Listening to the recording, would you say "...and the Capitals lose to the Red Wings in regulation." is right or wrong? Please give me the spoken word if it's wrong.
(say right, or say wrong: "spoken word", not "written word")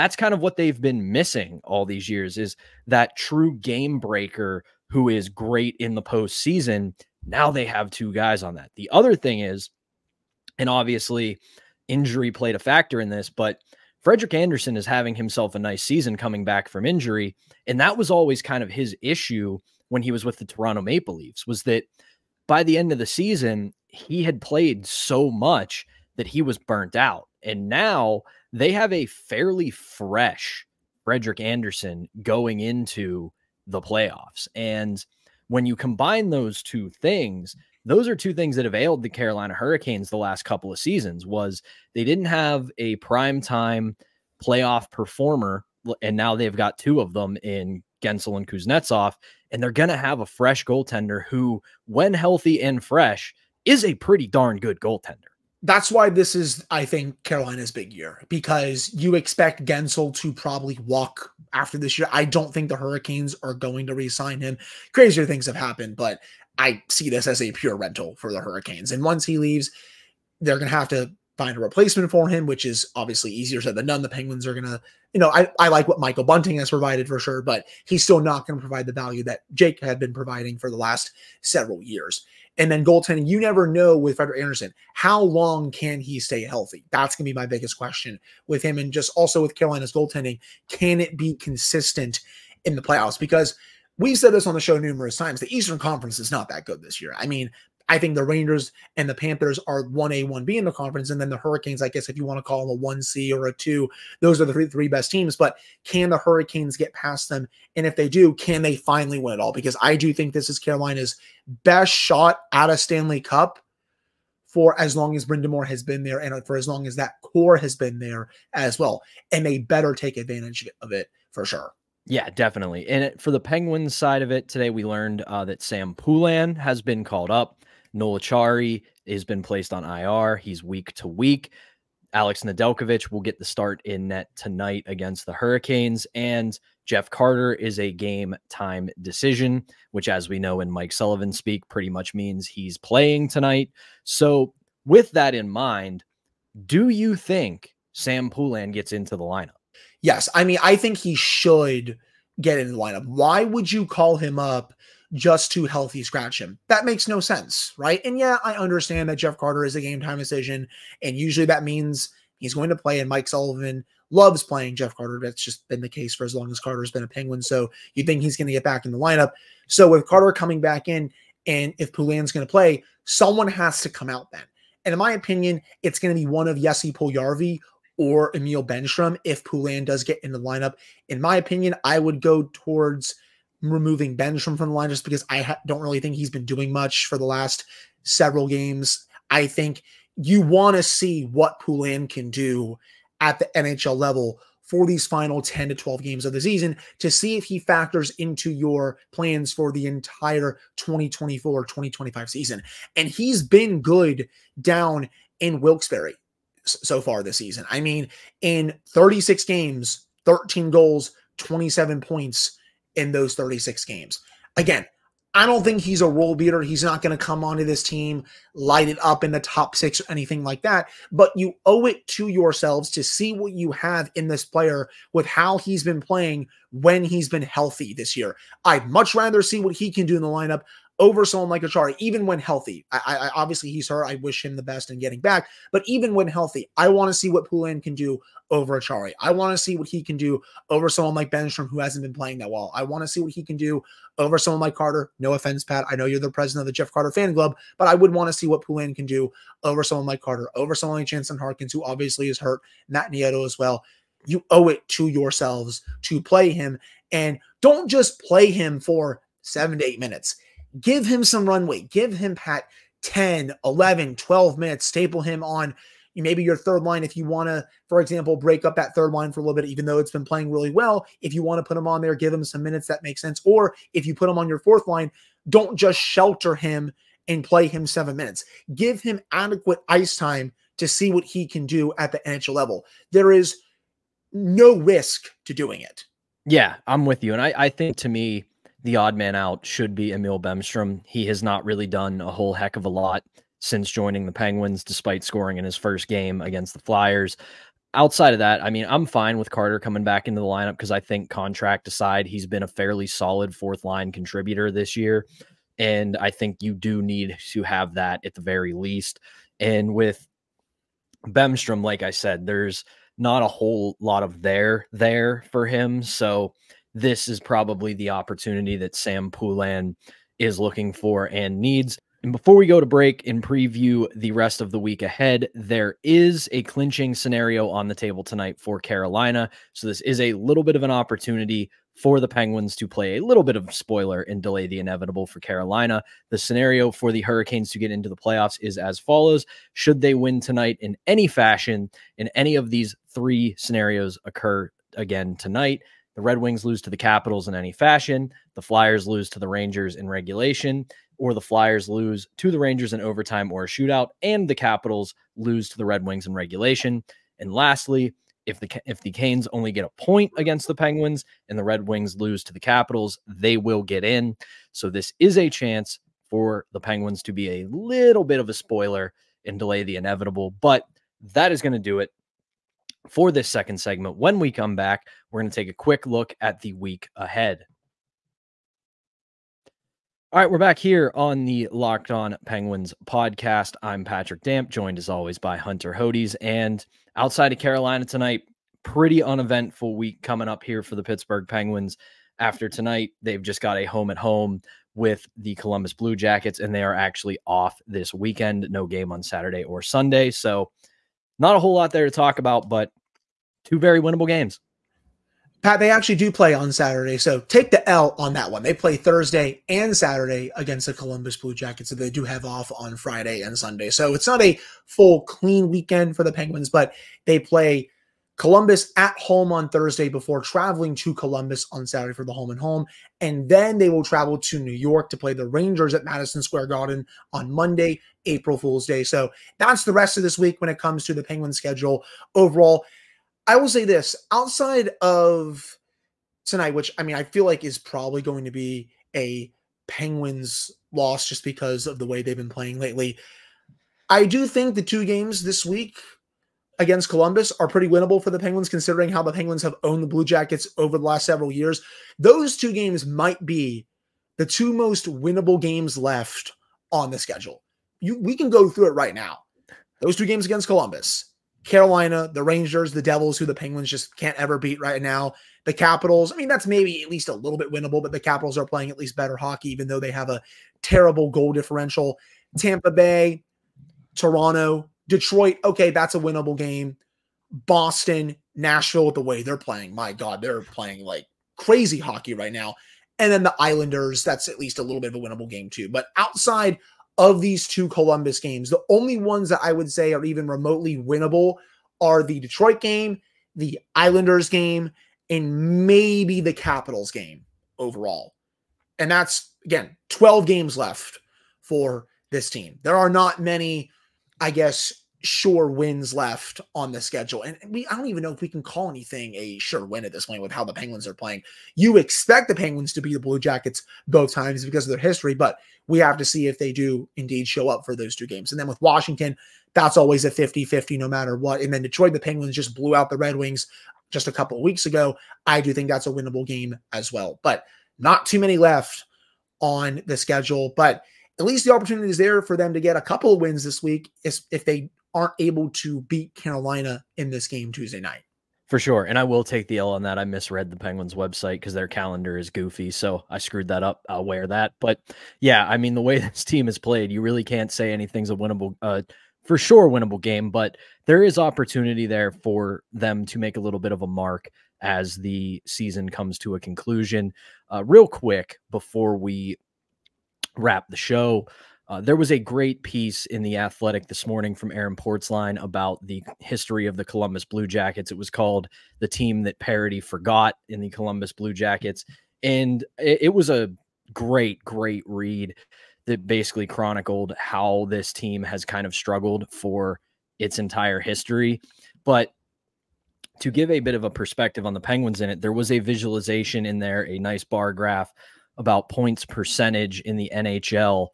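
right.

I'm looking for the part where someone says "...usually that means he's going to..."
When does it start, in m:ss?
2:41.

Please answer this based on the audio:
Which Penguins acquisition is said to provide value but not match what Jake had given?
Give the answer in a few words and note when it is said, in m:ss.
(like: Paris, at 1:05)
Michael Bunting, at 1:15.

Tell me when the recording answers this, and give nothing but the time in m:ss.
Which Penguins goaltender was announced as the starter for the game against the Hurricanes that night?
2:12.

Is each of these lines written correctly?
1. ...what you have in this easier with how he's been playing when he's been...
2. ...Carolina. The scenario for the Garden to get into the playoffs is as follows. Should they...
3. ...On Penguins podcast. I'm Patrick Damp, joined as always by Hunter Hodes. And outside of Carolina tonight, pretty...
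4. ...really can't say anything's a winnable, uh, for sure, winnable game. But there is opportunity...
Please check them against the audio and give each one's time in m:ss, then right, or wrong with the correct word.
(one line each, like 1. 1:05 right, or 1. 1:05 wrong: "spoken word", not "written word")
1. 3:43 wrong: "player", not "easier"
2. 5:35 wrong: "Hurricanes", not "Garden"
3. 6:22 right
4. 9:07 right.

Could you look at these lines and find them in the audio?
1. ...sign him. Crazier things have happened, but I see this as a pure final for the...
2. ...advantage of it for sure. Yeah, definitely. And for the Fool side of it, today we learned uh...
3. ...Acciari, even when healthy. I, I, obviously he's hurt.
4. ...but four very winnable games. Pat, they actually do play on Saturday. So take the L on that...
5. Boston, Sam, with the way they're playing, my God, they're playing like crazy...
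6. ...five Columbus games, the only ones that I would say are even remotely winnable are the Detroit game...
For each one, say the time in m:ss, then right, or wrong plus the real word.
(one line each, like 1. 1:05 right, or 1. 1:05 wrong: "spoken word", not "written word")
1. 1:04 wrong: "rental", not "final"
2. 2:00 wrong: "Penguins", not "Fool"
3. 3:51 right
4. 6:42 wrong: "two", not "four"
5. 7:57 wrong: "Nashville", not "Sam"
6. 8:07 wrong: "two", not "five".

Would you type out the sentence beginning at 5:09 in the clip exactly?
And with Bemstrom, like I said, there's not a whole lot of there there for him.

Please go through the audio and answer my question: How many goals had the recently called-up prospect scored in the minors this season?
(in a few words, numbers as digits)
13.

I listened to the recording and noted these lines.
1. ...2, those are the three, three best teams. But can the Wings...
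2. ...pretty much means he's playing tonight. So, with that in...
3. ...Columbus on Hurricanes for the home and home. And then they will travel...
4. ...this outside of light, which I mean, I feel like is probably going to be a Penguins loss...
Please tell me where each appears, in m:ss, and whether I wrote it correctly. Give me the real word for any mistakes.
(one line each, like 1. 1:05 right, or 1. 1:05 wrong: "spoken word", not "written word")
1. 1:43 wrong: "Hurricanes", not "Wings"
2. 2:21 right
3. 7:01 wrong: "Saturday", not "Hurricanes"
4. 7:13 wrong: "tonight", not "light".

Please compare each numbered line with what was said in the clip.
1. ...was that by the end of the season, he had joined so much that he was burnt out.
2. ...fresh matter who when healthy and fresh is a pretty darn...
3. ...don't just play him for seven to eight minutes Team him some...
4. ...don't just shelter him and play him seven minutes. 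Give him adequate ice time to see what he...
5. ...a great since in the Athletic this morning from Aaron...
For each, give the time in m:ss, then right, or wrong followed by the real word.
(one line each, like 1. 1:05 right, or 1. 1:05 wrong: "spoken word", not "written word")
1. 0:21 wrong: "played", not "joined"
2. 0:50 wrong: "goaltender", not "matter"
3. 4:17 wrong: "Give", not "Team"
4. 4:35 right
5. 9:22 wrong: "piece", not "since".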